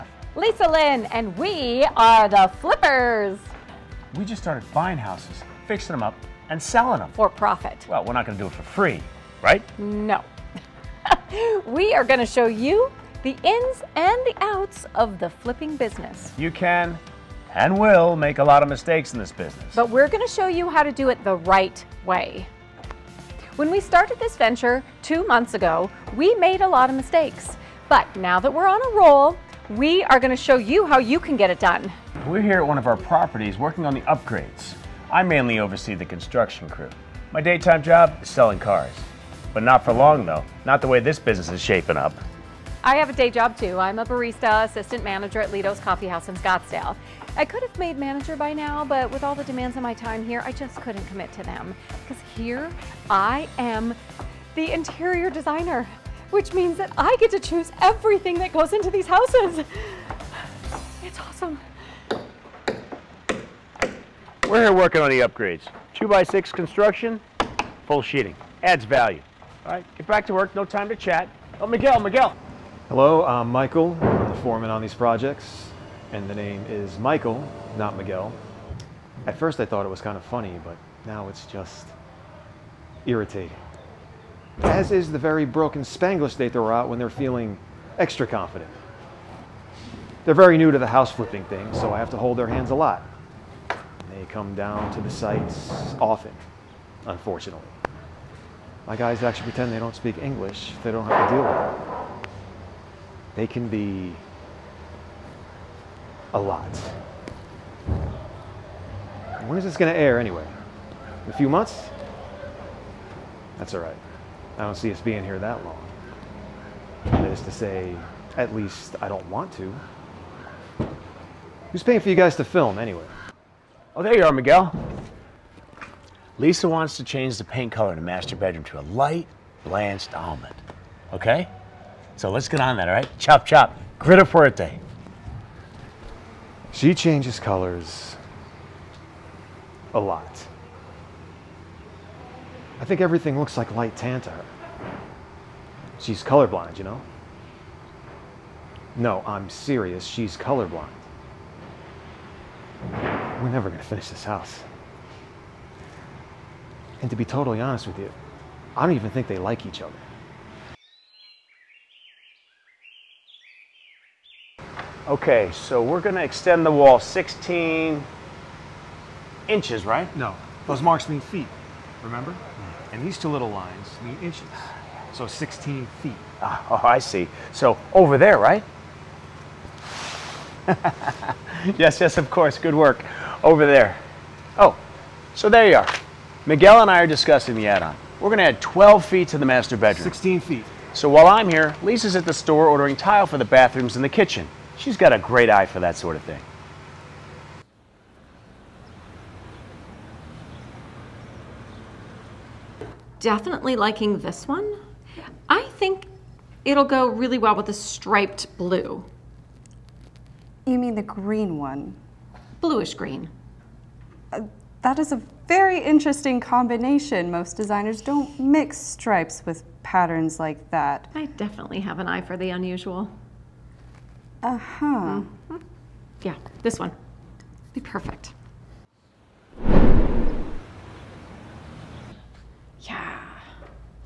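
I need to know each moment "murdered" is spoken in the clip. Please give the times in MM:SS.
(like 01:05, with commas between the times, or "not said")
not said.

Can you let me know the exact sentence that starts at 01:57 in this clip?
That is to say, at least I don't want to.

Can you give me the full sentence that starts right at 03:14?
She's got a great eye for that sort of thing.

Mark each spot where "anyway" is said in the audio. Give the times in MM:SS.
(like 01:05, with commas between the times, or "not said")
01:50, 02:02.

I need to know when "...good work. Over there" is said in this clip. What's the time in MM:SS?
03:02.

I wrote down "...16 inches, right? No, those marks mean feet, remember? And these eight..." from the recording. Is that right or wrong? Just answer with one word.
wrong.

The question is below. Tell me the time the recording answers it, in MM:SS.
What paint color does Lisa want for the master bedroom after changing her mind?
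02:08.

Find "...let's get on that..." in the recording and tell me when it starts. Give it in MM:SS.
02:12.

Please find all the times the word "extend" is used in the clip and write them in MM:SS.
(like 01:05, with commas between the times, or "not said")
02:46.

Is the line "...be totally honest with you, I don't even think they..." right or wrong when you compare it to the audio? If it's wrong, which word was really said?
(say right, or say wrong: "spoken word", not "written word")
right.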